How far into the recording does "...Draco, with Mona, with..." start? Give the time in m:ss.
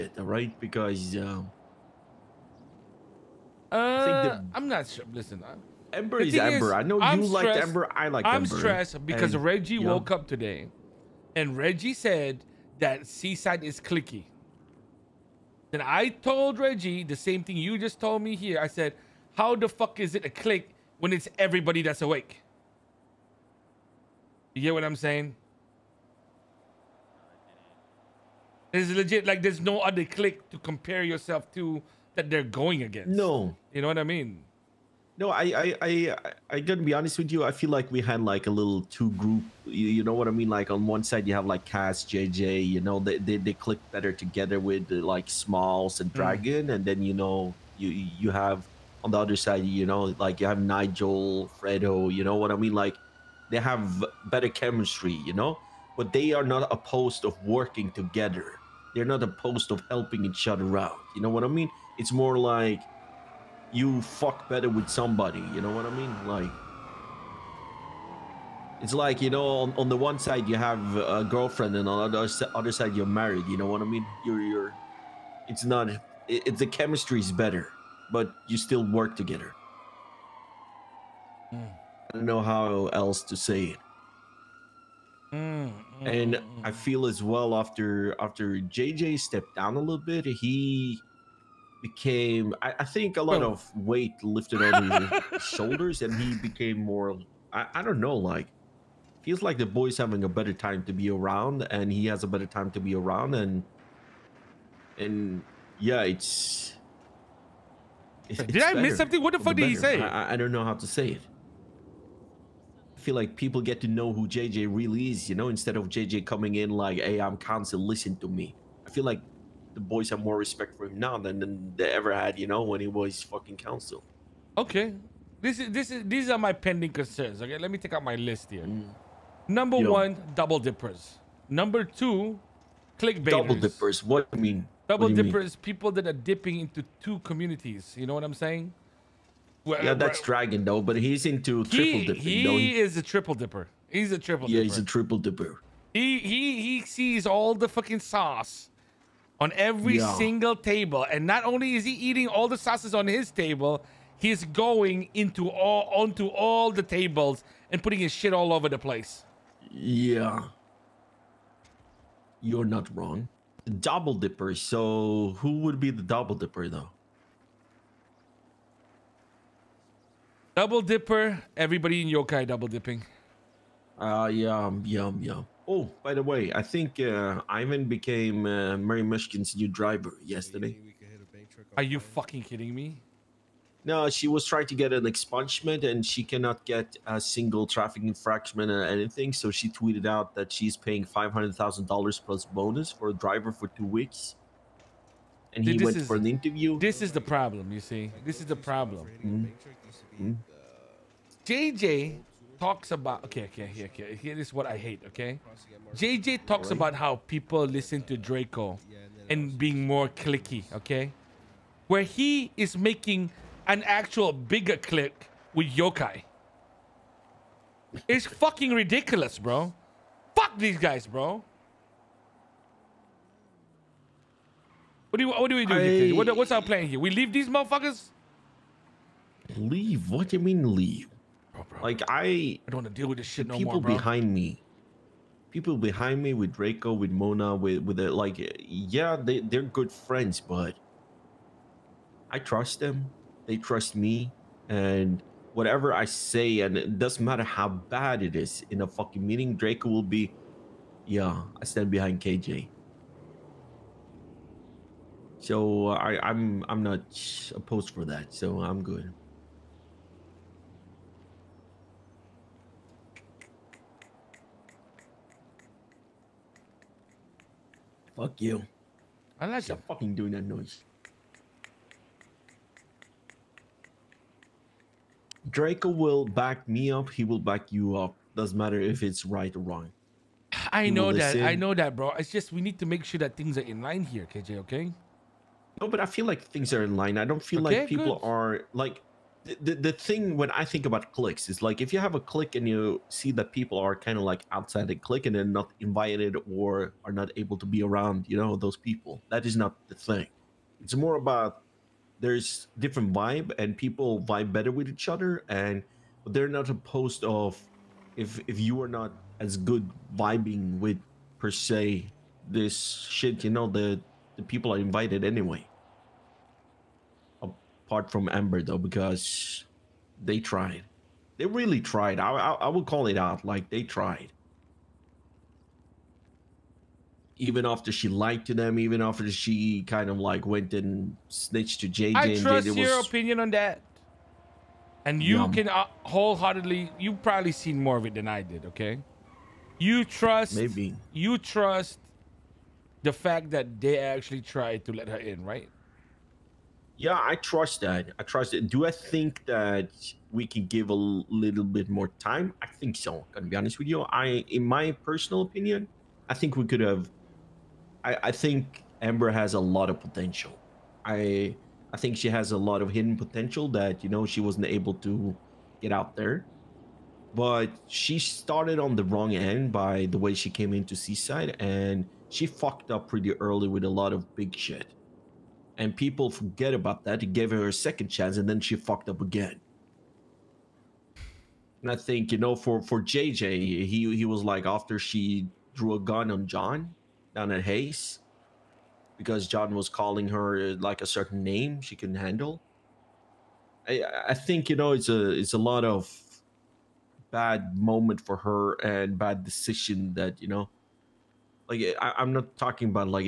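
3:56.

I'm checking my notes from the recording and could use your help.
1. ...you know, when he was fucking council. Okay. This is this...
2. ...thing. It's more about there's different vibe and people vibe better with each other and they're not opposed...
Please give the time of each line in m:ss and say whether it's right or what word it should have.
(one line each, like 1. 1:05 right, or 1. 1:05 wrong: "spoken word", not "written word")
1. 2:02 right
2. 4:59 right.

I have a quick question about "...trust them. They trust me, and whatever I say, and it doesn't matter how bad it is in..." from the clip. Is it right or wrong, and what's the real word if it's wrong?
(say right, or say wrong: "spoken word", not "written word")
right.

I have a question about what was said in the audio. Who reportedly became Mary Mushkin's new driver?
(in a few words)
Ivan.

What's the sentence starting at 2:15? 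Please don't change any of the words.
people that are dipping into two communities.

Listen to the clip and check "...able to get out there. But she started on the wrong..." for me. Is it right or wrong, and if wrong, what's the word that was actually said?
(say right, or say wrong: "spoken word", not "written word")
right.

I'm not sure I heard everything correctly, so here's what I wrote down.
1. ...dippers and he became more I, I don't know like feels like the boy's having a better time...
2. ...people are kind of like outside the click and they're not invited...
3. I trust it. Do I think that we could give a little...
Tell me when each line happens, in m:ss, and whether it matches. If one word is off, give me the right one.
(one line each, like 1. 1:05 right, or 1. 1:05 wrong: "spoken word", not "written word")
1. 1:35 wrong: "shoulders", not "dippers"
2. 4:53 right
3. 5:48 right.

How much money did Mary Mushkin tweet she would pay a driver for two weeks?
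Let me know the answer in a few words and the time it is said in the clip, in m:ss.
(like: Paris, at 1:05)
$500,000, at 3:11.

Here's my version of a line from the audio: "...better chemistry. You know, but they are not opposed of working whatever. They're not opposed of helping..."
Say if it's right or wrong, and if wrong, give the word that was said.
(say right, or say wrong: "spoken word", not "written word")
wrong: "together", not "whatever".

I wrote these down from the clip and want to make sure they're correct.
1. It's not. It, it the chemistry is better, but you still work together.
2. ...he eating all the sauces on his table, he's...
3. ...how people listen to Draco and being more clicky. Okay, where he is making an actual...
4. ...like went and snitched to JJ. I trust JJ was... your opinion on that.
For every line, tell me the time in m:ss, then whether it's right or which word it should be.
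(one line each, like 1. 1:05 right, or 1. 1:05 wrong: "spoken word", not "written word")
1. 1:15 right
2. 2:31 right
3. 3:26 right
4. 5:30 right.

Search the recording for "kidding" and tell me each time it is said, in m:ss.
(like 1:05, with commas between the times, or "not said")
3:02.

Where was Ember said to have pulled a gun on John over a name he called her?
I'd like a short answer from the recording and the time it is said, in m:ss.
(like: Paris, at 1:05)
Hayes, at 6:27.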